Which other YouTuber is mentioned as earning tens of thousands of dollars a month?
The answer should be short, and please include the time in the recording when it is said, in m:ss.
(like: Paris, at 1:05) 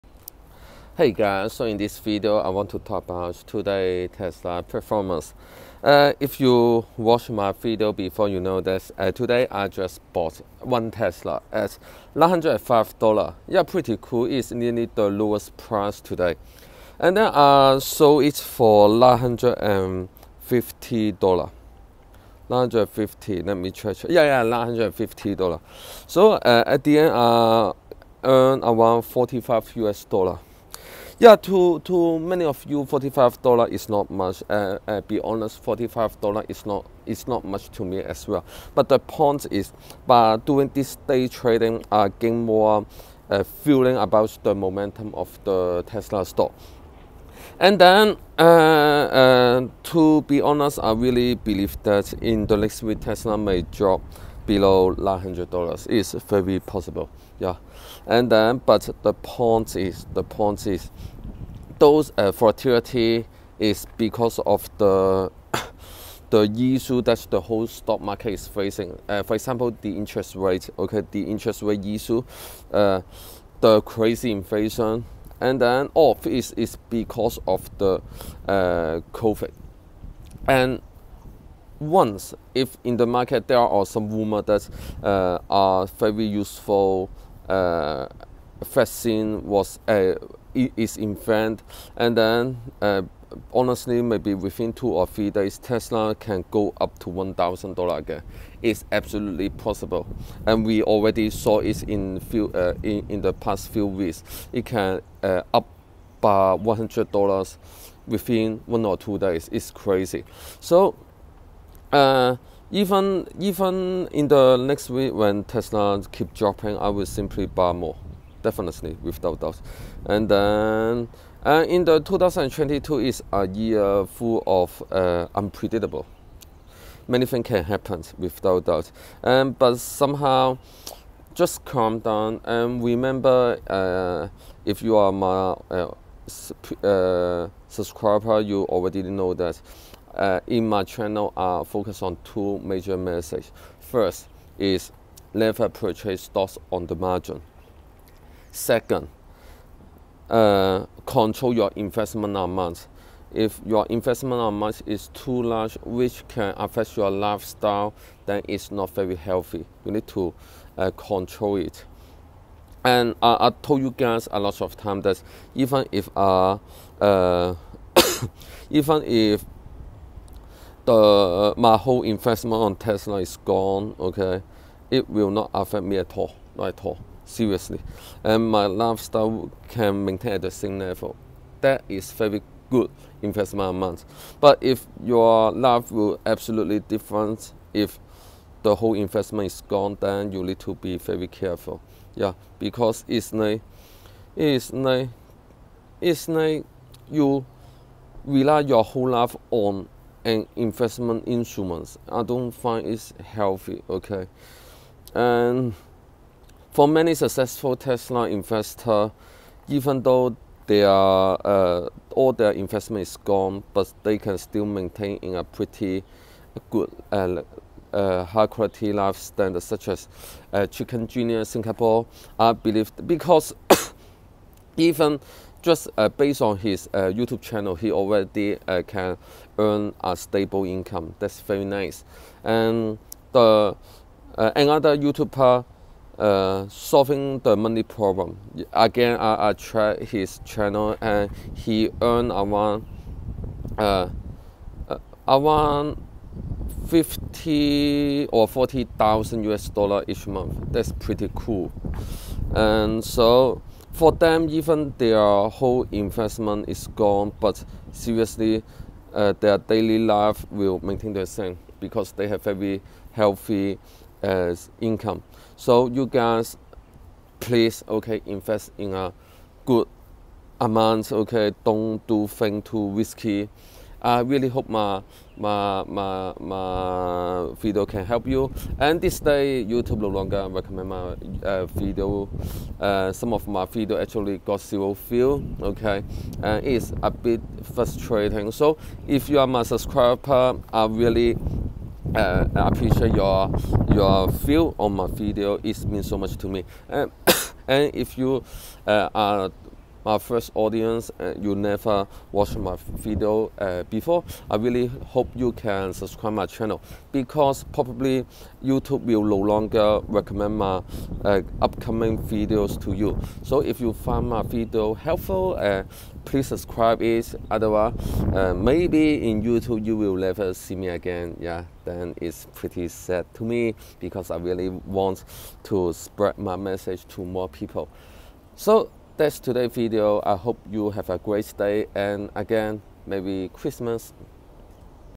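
Solving the Money Problem, at 3:56.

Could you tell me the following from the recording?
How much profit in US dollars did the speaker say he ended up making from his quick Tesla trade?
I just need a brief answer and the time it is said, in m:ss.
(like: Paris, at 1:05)
$45, at 0:27.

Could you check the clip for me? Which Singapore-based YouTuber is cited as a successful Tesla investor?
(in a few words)
Chicken Genius Singapore.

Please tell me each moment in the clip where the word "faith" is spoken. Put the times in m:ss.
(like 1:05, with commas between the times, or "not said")
not said.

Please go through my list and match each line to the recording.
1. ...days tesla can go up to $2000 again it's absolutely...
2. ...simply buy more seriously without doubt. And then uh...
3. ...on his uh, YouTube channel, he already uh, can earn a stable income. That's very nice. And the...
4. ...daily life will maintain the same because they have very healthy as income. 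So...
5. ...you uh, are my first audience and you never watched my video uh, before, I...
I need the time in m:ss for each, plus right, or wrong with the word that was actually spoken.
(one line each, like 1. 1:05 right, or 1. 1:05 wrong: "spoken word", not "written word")
1. 1:35 wrong: "1000", not "2000"
2. 1:57 wrong: "definitely", not "seriously"
3. 3:46 right
4. 4:19 right
5. 4:58 right.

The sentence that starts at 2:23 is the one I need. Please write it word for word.
First is never purchase stocks on the margin.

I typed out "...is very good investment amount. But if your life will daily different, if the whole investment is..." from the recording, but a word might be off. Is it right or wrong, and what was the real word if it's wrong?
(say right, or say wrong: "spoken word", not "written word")
wrong: "absolutely", not "daily".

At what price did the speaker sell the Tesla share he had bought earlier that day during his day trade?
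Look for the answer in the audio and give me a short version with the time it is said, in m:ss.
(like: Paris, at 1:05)
$950, at 0:17.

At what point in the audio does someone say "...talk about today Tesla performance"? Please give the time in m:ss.
0:02.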